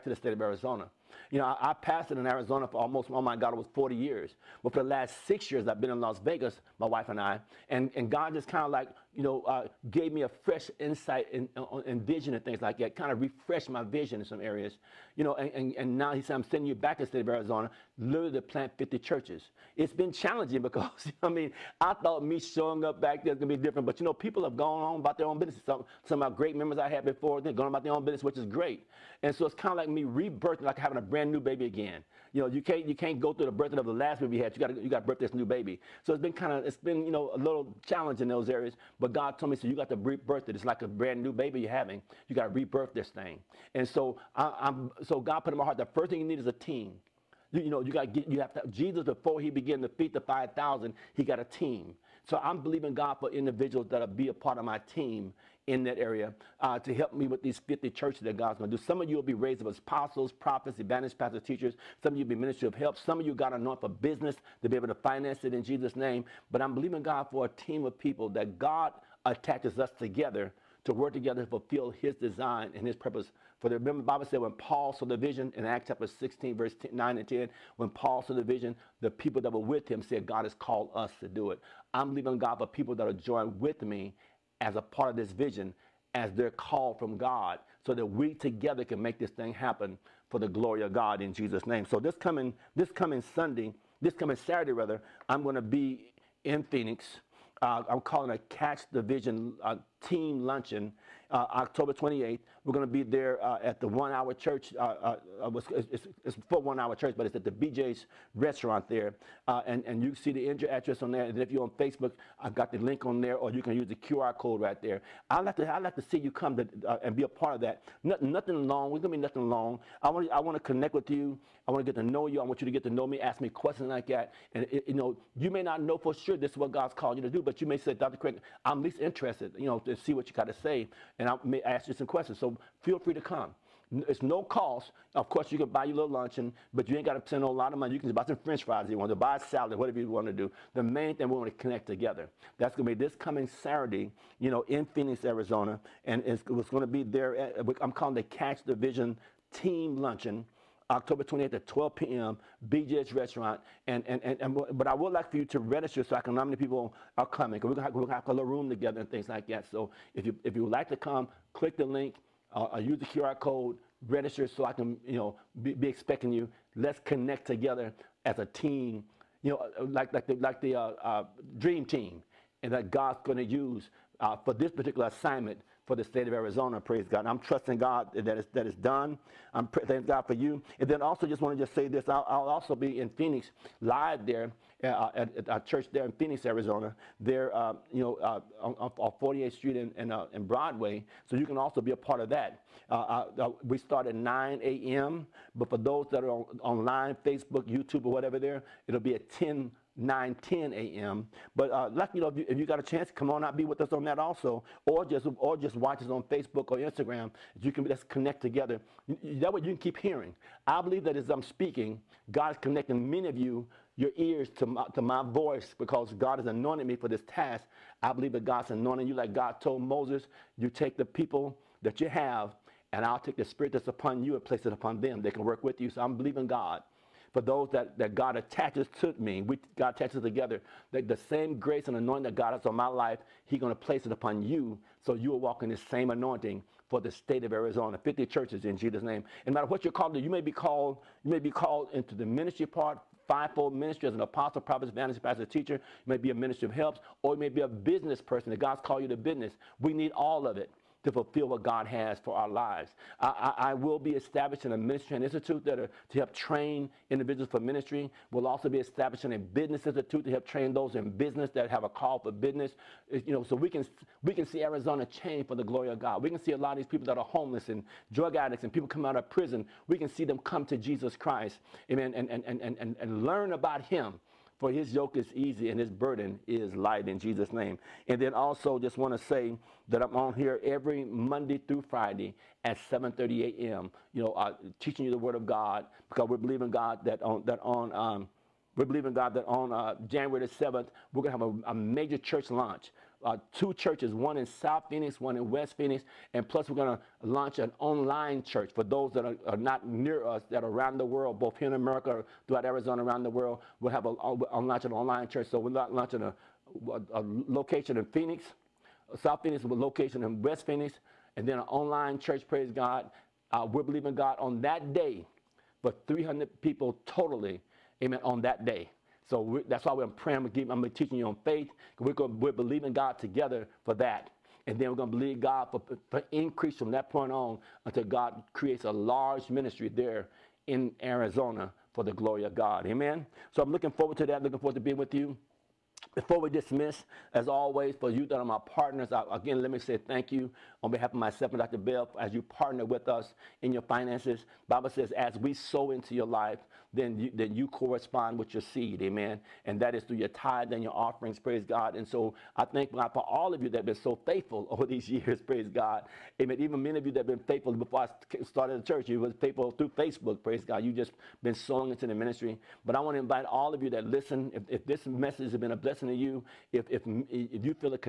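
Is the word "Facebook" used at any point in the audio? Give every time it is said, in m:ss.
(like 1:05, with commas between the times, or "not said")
1:51, 3:17, 3:26, 5:59.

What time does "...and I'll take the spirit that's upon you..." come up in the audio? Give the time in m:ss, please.
3:42.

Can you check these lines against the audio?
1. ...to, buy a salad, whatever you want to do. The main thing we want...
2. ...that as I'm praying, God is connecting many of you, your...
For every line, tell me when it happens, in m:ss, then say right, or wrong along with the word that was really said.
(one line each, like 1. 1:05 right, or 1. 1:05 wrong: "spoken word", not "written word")
1. 2:19 right
2. 3:31 wrong: "speaking", not "praying".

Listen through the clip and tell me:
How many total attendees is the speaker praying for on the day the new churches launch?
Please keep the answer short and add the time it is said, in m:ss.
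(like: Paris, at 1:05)
300, at 5:16.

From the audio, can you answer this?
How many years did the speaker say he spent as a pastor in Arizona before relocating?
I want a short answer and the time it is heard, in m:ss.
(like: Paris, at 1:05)
40, at 0:03.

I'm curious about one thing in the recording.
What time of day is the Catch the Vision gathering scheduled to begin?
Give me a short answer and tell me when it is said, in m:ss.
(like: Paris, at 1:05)
12 p.m., at 2:31.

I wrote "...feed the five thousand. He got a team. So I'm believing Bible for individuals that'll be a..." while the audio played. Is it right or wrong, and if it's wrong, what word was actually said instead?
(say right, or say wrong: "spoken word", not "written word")
wrong: "God", not "Bible".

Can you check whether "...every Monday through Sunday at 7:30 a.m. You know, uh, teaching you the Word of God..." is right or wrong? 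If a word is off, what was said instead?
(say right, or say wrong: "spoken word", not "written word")
wrong: "Friday", not "Sunday".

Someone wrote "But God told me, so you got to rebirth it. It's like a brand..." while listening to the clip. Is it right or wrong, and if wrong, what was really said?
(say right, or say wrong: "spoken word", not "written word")
right.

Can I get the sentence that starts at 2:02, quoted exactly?
I want you to get to know me, ask me questions like that.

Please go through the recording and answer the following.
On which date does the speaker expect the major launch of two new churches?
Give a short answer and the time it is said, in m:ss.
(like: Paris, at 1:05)
January 7, at 4:50.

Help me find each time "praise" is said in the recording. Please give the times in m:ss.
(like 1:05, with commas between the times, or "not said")
2:56, 5:12, 5:51, 5:55, 6:00.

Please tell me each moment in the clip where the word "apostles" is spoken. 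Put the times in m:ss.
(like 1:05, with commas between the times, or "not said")
0:59, 4:04.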